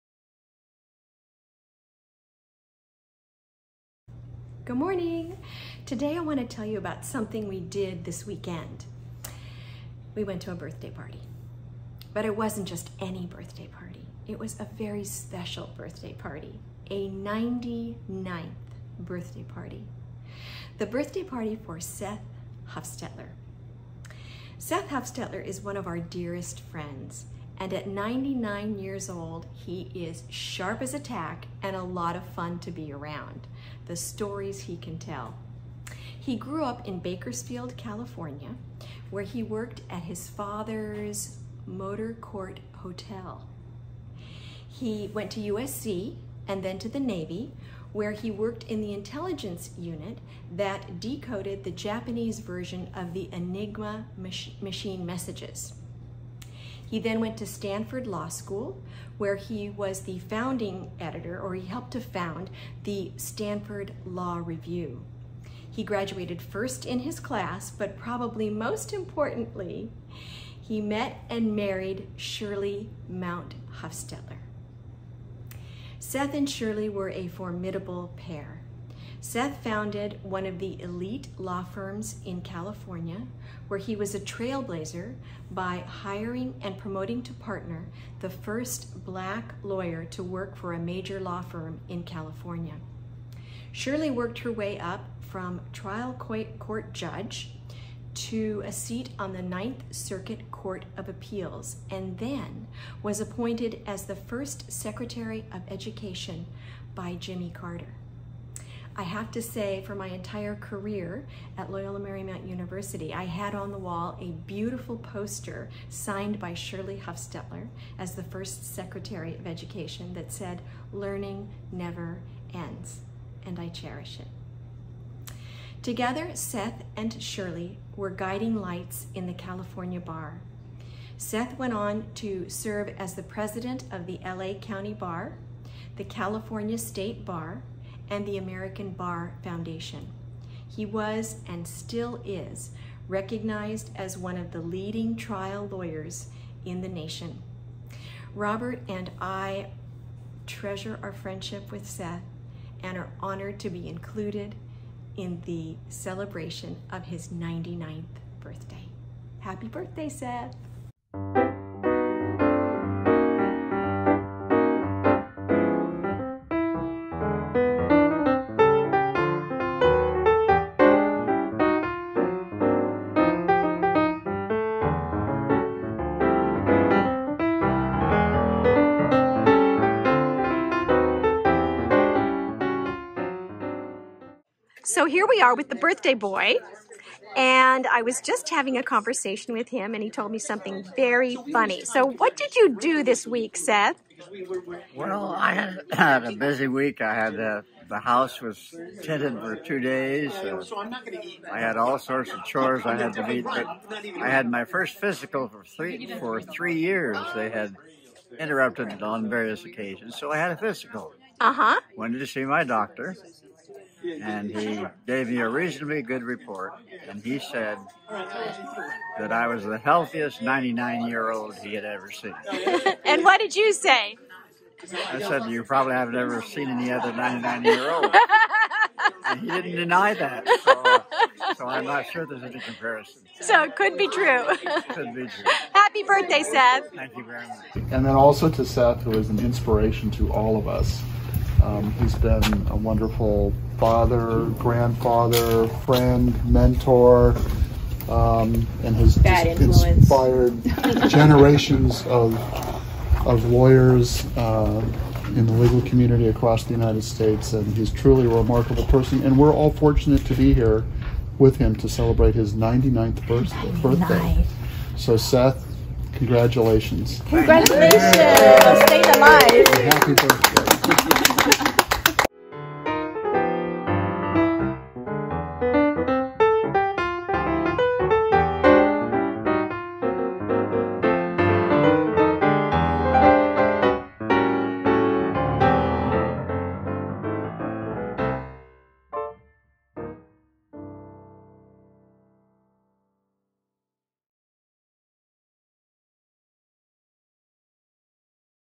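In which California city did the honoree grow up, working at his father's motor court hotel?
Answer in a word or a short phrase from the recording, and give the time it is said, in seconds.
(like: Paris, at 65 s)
Bakersfield, at 36 s.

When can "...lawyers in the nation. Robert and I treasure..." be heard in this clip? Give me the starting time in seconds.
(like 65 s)
145 s.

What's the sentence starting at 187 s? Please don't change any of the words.
And I was just having a conversation with him, and he told me something very funny.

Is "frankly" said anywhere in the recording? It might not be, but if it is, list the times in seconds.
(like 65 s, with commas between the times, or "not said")
not said.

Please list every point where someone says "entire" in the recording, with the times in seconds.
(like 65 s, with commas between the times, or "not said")
110 s.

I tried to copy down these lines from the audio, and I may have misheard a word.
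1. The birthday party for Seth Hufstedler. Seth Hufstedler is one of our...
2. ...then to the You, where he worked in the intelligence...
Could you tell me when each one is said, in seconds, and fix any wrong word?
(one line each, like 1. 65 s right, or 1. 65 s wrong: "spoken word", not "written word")
1. 20 s right
2. 46 s wrong: "Navy", not "You".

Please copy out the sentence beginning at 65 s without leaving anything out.
He graduated first in his class, but probably most importantly, he met and married Shirley Mount Hufstedler.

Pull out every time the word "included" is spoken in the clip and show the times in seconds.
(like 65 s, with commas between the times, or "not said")
153 s.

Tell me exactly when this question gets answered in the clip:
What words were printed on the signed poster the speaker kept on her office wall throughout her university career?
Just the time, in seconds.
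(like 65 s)
120 s.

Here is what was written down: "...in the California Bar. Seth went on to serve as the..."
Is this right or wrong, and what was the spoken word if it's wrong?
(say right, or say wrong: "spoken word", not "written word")
right.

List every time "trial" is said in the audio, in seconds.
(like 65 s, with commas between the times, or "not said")
95 s, 145 s.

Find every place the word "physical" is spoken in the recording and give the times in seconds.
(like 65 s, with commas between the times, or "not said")
204 s, 210 s.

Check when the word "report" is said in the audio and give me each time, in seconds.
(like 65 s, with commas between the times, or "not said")
216 s.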